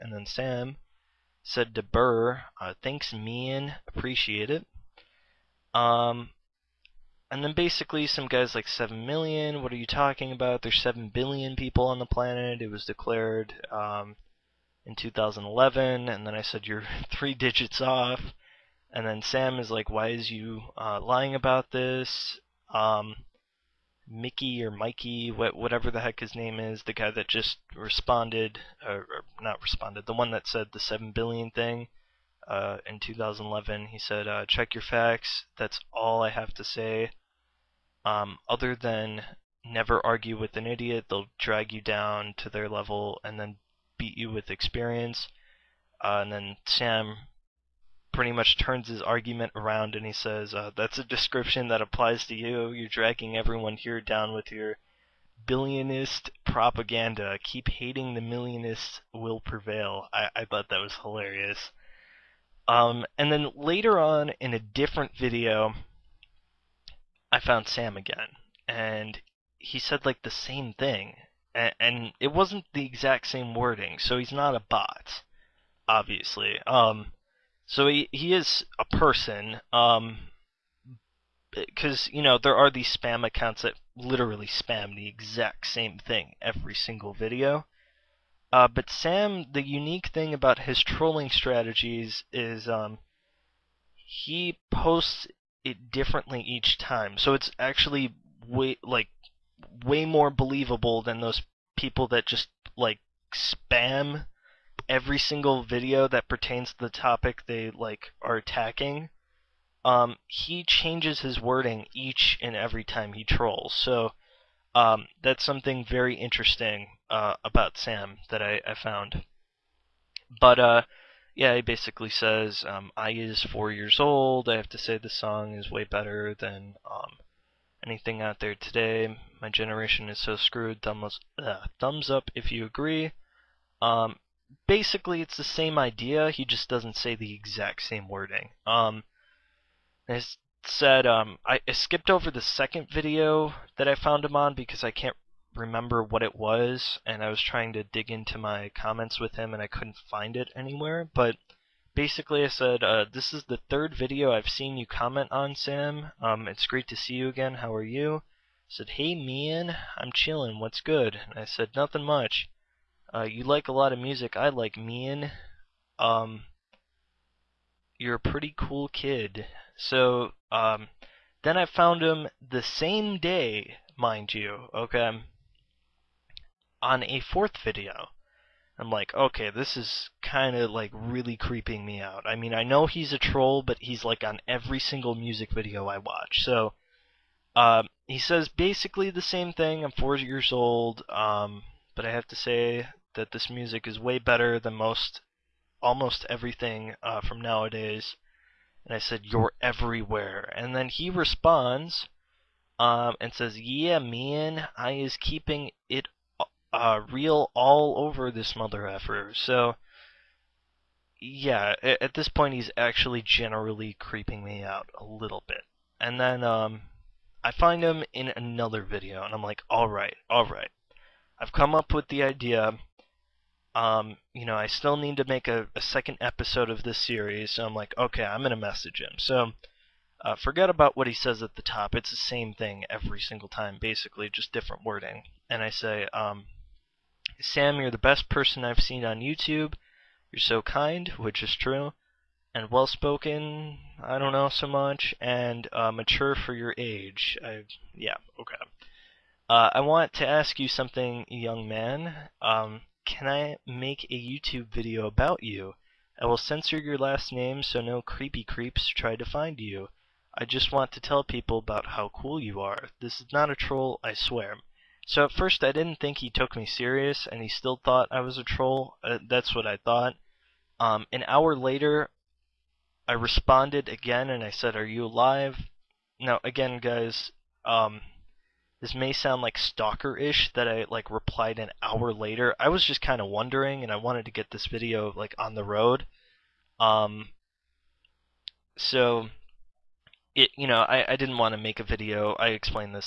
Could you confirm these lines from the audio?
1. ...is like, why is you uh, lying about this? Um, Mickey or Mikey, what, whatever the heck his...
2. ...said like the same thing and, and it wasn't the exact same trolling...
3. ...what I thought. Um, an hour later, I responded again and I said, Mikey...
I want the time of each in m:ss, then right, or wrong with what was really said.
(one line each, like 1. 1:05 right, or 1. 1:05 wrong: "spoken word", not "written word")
1. 0:19 right
2. 1:09 wrong: "wording", not "trolling"
3. 4:29 wrong: "Are", not "Mikey".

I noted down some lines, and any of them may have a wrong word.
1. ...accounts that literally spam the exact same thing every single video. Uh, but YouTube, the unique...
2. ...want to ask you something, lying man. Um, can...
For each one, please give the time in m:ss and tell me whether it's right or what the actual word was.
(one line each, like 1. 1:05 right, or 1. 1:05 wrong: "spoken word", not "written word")
1. 1:23 wrong: "Sam", not "YouTube"
2. 4:09 wrong: "young", not "lying".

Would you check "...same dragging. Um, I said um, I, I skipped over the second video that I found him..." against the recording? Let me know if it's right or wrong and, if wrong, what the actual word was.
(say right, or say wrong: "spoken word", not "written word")
wrong: "wording", not "dragging".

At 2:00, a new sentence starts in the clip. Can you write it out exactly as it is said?
But uh, yeah, he basically says, um, I is four years old.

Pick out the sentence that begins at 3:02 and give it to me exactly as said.
I mean, I know he's a troll, but he's like on every single music video I watch.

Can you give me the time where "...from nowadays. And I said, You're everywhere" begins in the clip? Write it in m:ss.
3:17.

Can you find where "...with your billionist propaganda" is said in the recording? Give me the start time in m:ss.
0:54.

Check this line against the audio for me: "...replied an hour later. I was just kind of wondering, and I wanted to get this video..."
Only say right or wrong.
right.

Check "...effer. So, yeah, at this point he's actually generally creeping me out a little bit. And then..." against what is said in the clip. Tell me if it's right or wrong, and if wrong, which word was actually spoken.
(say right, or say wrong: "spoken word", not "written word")
right.